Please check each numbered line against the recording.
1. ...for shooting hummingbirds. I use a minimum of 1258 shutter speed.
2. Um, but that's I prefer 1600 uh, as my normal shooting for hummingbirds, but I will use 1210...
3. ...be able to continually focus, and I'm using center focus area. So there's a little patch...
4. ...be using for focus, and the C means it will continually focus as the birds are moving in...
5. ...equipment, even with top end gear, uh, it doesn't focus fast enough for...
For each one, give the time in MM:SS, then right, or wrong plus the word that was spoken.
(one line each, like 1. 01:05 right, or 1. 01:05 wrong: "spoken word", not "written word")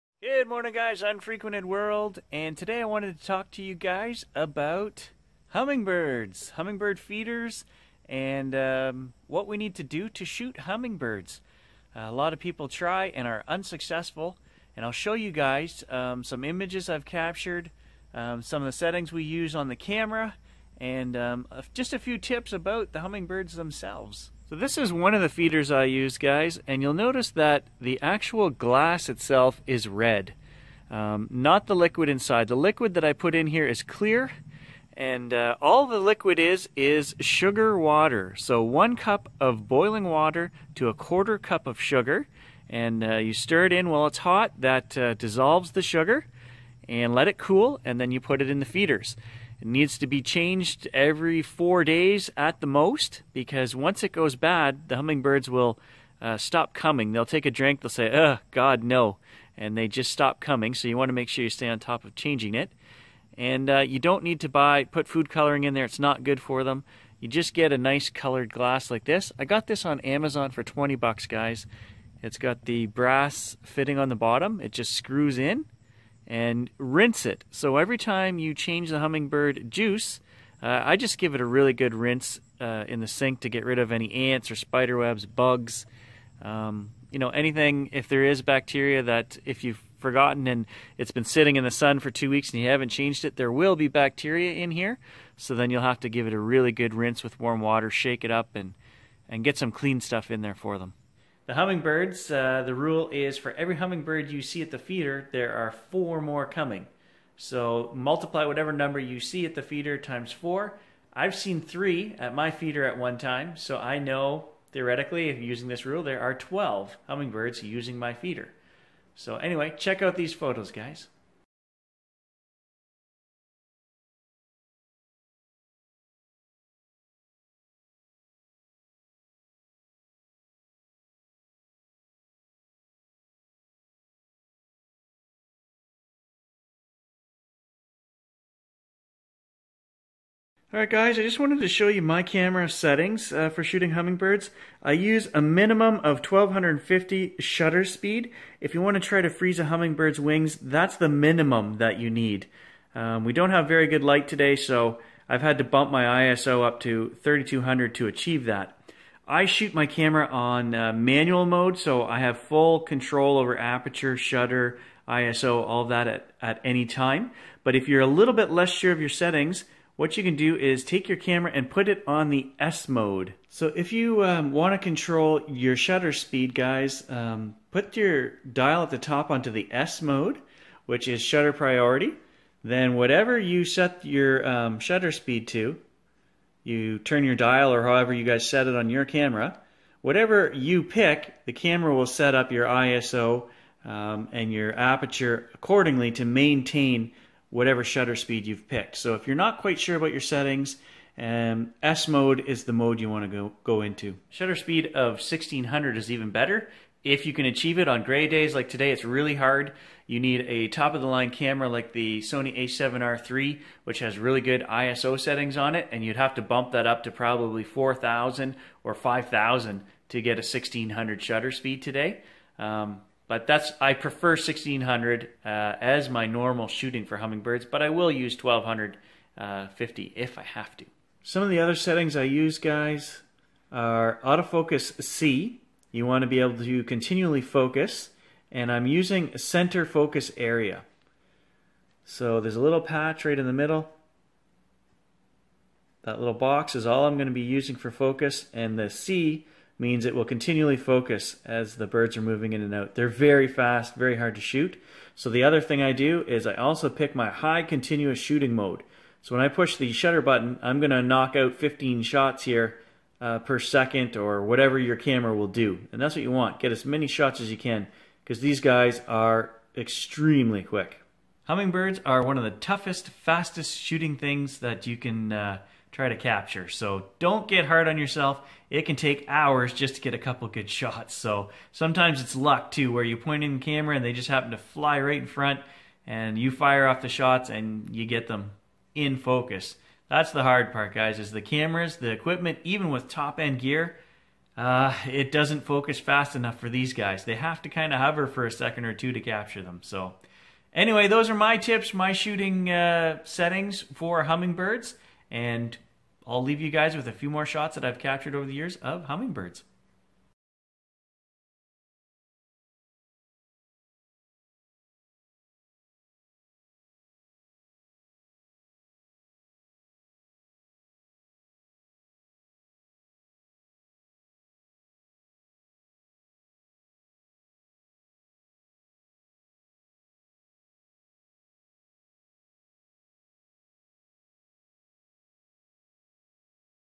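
1. 02:23 wrong: "1250", not "1258"
2. 03:42 wrong: "1250", not "1210"
3. 03:56 right
4. 04:07 right
5. 04:52 right.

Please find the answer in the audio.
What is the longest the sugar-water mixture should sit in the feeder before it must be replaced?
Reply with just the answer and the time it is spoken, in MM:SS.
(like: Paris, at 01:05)
4 days, at 00:51.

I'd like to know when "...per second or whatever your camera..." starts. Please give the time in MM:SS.
04:23.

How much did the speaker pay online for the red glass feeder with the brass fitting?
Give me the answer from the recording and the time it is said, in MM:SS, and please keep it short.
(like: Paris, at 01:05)
20 bucks, at 01:10.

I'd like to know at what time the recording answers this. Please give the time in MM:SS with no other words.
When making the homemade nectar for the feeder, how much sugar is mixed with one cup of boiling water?
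00:40.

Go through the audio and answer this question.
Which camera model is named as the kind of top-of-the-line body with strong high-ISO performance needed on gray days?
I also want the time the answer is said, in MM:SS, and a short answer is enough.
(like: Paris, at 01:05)
Sony a7R III, at 03:32.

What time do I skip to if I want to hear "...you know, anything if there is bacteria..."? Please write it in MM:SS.
01:27.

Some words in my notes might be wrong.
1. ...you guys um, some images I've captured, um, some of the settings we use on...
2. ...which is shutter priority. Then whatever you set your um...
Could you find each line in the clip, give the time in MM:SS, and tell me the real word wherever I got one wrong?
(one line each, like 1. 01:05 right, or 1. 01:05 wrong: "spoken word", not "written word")
1. 00:15 right
2. 03:00 right.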